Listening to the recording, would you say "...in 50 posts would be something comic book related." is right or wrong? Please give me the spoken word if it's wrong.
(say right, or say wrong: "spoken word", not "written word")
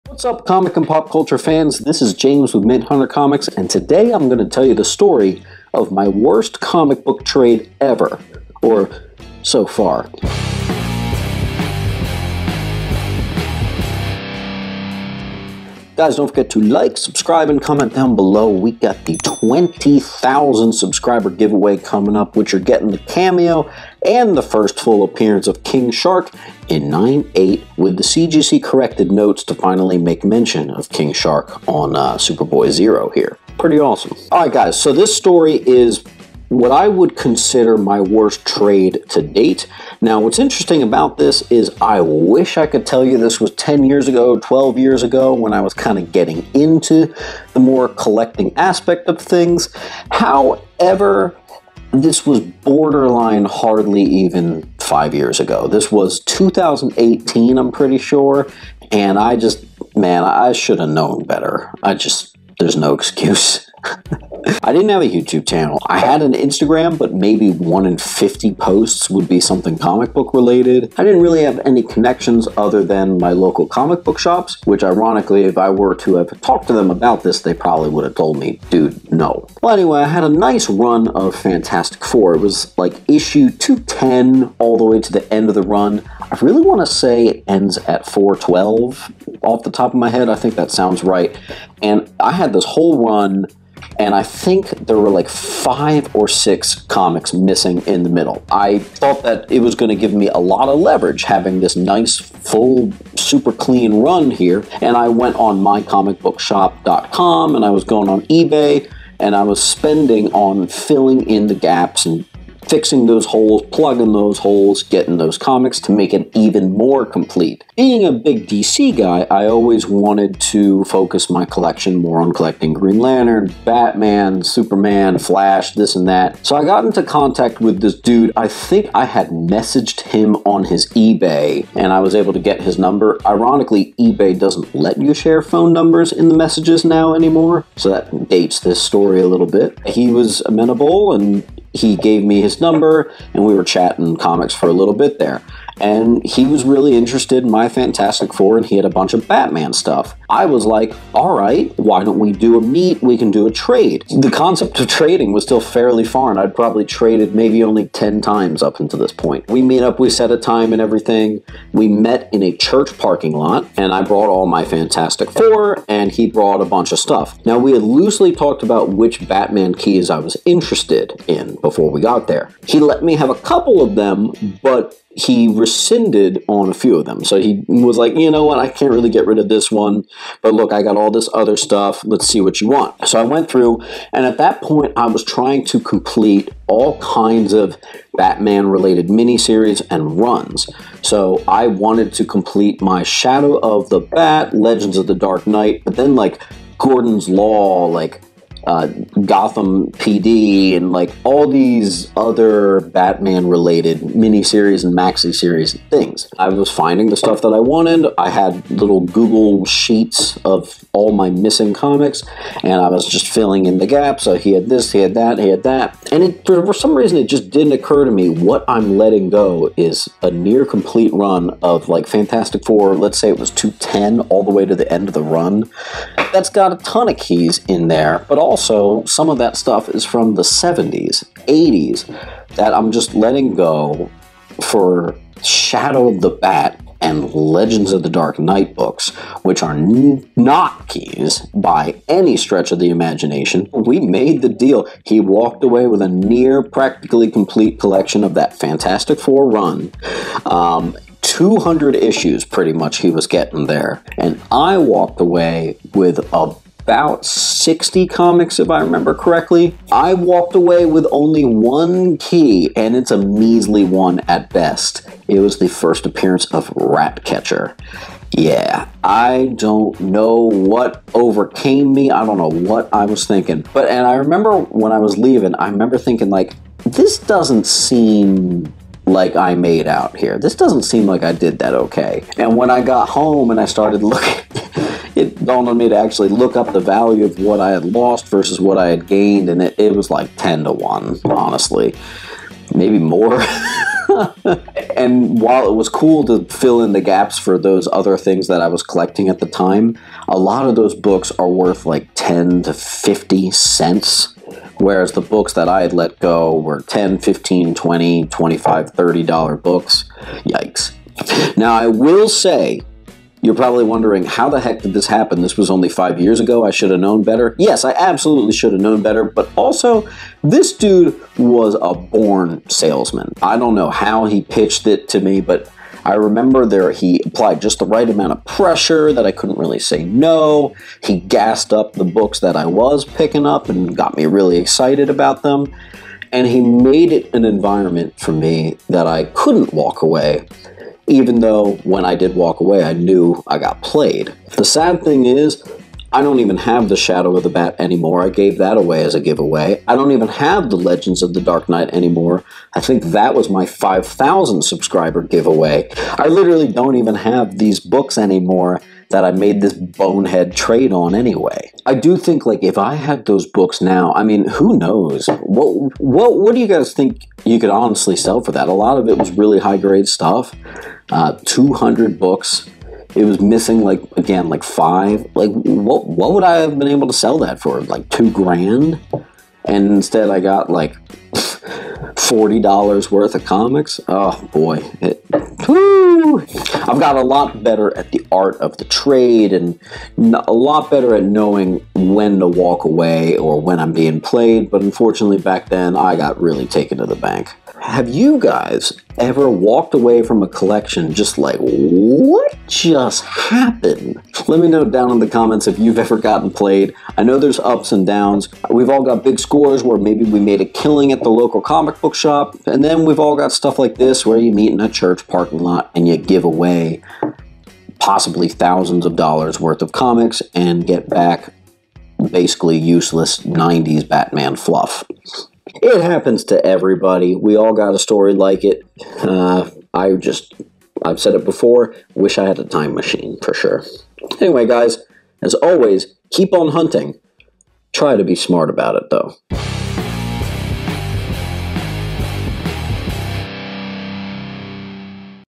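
right.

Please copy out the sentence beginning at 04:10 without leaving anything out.
Um, 200 issues, pretty much, he was getting there.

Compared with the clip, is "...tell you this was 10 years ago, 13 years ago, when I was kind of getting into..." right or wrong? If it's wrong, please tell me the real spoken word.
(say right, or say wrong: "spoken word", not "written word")
wrong: "12", not "13".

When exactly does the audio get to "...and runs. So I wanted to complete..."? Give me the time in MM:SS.
03:09.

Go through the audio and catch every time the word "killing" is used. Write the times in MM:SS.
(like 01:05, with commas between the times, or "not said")
06:50.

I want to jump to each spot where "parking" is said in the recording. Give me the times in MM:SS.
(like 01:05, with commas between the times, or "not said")
02:42, 06:55.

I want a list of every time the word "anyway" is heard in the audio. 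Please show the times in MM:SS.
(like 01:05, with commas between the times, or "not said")
01:19, 06:01, 07:14.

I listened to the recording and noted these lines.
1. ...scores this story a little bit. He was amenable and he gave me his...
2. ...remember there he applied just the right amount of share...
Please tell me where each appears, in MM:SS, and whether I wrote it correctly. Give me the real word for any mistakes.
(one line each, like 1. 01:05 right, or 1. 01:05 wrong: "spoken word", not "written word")
1. 02:18 wrong: "dates", not "scores"
2. 05:26 wrong: "pressure", not "share".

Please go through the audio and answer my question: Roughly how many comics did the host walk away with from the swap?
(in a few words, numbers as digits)
60.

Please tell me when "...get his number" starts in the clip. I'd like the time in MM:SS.
02:12.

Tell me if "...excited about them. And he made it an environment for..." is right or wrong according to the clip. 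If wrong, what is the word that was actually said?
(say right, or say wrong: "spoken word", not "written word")
right.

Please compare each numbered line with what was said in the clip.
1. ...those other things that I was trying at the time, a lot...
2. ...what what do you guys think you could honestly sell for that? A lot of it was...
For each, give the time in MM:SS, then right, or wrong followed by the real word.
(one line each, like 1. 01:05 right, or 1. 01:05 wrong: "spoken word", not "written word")
1. 04:57 wrong: "collecting", not "trying"
2. 06:05 right.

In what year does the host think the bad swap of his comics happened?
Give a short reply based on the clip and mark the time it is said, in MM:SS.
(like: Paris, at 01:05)
2018, at 00:56.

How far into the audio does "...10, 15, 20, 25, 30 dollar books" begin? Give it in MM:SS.
05:06.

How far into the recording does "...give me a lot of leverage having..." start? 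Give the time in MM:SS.
01:39.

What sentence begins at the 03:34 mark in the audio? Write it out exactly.
So he had this, he had that, he had that.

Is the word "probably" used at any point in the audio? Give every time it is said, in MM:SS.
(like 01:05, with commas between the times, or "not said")
01:17, 02:36, 05:13.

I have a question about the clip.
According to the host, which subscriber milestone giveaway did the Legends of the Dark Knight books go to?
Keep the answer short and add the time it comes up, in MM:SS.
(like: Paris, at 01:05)
5,000, at 05:53.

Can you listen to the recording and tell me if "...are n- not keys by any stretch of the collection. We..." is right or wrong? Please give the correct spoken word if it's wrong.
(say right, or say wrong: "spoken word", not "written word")
wrong: "imagination", not "collection".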